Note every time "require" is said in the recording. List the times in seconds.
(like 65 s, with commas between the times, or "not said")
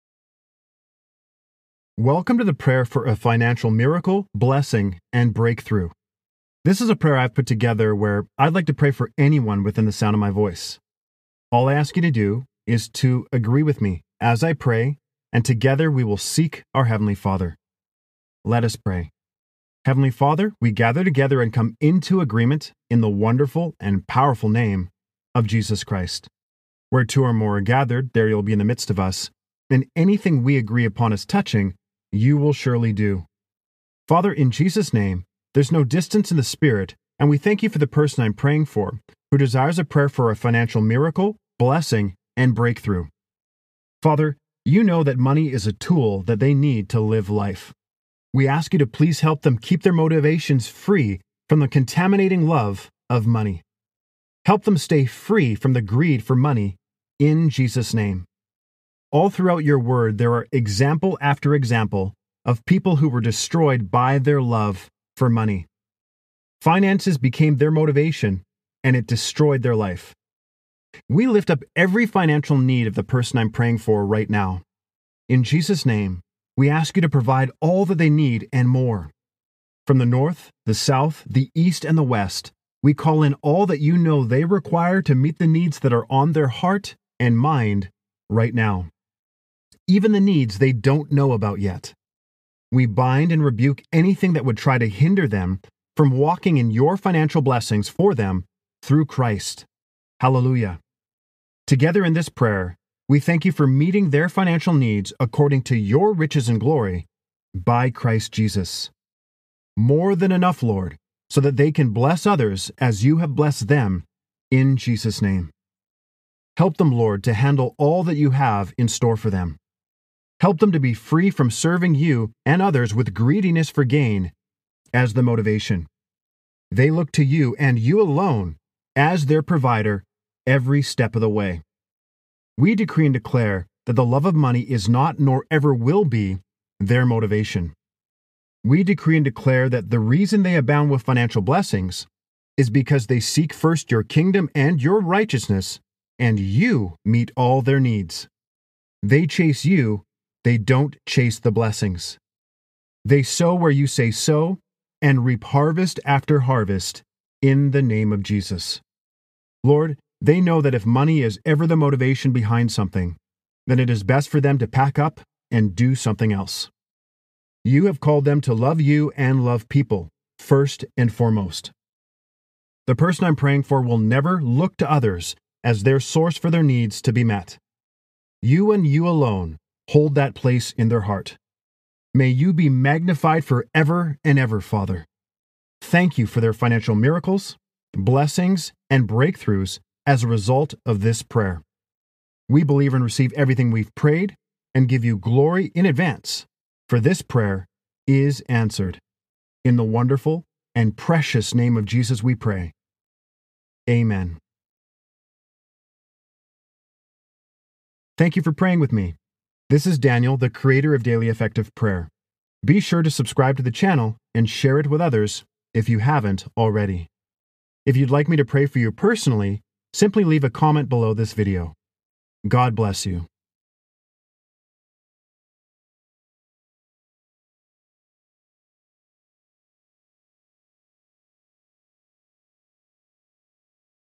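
84 s.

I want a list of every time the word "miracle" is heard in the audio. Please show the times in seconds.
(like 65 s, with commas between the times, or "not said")
3 s, 40 s, 186 s.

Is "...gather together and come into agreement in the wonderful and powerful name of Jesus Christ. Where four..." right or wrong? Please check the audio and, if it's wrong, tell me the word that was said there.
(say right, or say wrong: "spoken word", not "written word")
wrong: "two", not "four".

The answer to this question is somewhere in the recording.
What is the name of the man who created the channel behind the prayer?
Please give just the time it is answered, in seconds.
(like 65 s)
209 s.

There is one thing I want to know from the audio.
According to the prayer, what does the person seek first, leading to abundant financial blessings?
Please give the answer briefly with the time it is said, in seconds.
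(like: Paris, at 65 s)
Your kingdom, at 143 s.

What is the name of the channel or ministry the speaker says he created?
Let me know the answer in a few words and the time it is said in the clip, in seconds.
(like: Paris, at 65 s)
Daily Effective Prayer, at 211 s.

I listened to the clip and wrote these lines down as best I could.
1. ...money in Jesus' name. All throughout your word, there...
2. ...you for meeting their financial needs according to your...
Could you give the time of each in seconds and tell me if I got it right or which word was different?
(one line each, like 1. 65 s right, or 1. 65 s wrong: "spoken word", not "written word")
1. 56 s right
2. 103 s right.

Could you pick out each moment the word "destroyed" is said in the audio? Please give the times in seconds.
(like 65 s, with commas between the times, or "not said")
63 s, 69 s.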